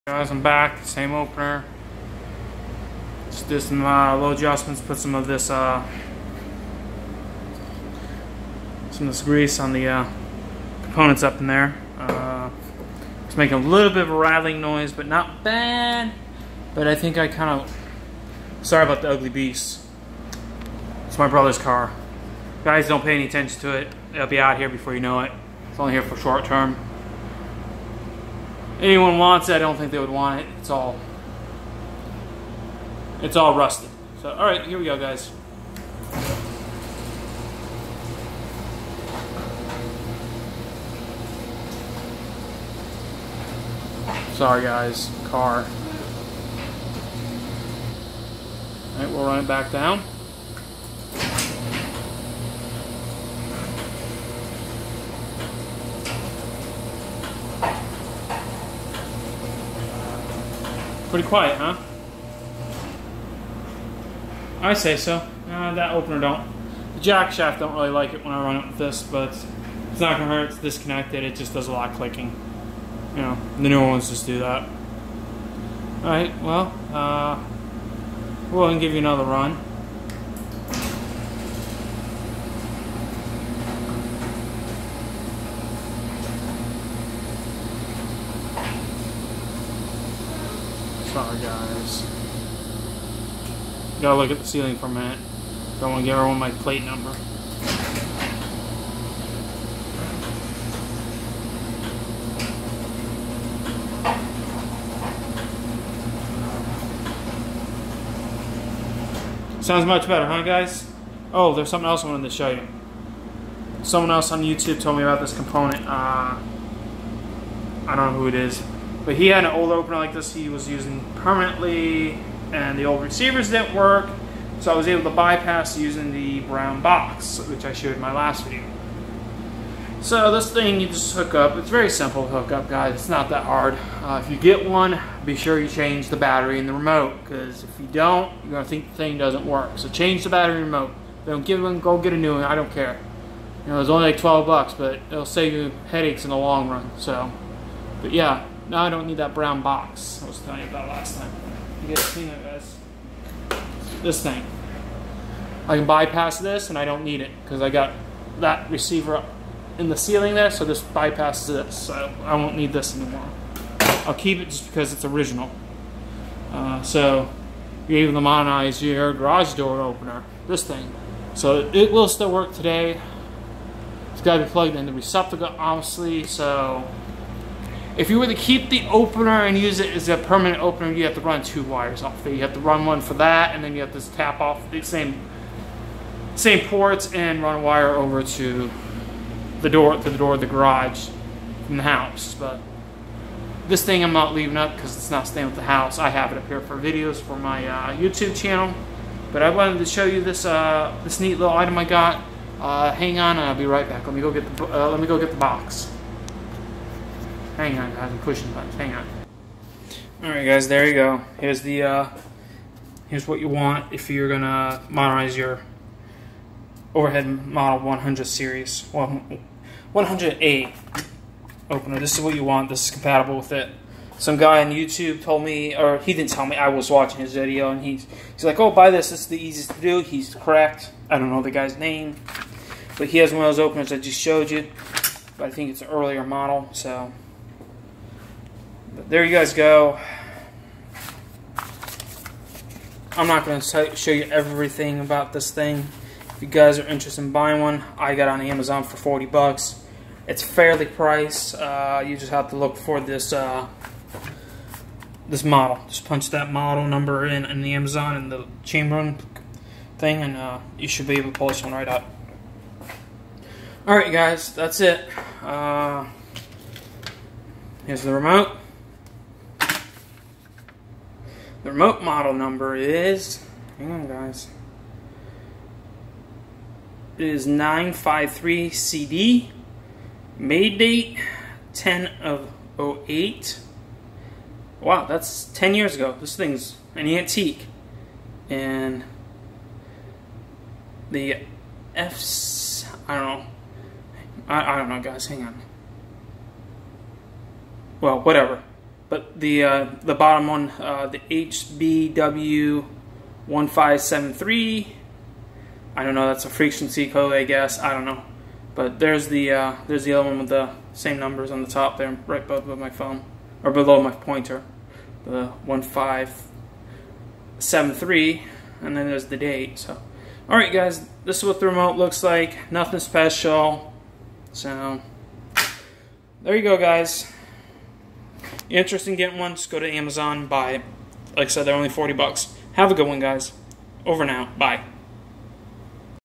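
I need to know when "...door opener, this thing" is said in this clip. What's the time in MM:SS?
02:49.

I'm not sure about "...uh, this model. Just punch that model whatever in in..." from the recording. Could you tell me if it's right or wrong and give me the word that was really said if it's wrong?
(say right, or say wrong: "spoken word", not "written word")
wrong: "number", not "whatever".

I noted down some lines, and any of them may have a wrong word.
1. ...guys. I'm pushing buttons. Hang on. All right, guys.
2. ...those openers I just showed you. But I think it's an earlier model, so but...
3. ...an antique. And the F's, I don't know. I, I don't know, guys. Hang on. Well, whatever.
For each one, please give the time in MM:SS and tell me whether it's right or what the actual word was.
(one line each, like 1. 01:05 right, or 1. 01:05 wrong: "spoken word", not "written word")
1. 03:27 right
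2. 03:53 right
3. 04:46 right.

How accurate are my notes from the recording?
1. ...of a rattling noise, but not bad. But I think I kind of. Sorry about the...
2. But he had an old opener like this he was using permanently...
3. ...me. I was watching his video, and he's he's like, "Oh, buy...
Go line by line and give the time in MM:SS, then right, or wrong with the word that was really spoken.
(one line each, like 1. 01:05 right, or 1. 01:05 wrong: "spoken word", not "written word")
1. 00:14 right
2. 01:59 right
3. 03:46 right.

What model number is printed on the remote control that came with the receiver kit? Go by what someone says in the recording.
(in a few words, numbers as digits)
953CD.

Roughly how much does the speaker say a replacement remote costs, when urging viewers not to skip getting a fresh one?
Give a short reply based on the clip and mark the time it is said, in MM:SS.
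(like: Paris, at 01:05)
12 bucks, at 02:24.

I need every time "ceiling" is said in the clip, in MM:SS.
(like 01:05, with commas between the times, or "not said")
01:34, 02:39.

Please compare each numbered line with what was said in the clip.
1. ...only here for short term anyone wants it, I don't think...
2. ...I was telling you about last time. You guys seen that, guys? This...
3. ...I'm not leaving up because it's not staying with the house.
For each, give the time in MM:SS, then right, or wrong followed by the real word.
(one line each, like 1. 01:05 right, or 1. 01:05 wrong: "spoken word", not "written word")
1. 00:25 right
2. 02:30 right
3. 03:14 right.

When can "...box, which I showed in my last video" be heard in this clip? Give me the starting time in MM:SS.
02:06.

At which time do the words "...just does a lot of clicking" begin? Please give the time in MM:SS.
01:11.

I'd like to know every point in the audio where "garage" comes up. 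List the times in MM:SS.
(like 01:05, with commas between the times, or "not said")
02:49, 03:10.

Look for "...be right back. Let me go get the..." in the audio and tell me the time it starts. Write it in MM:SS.
03:23.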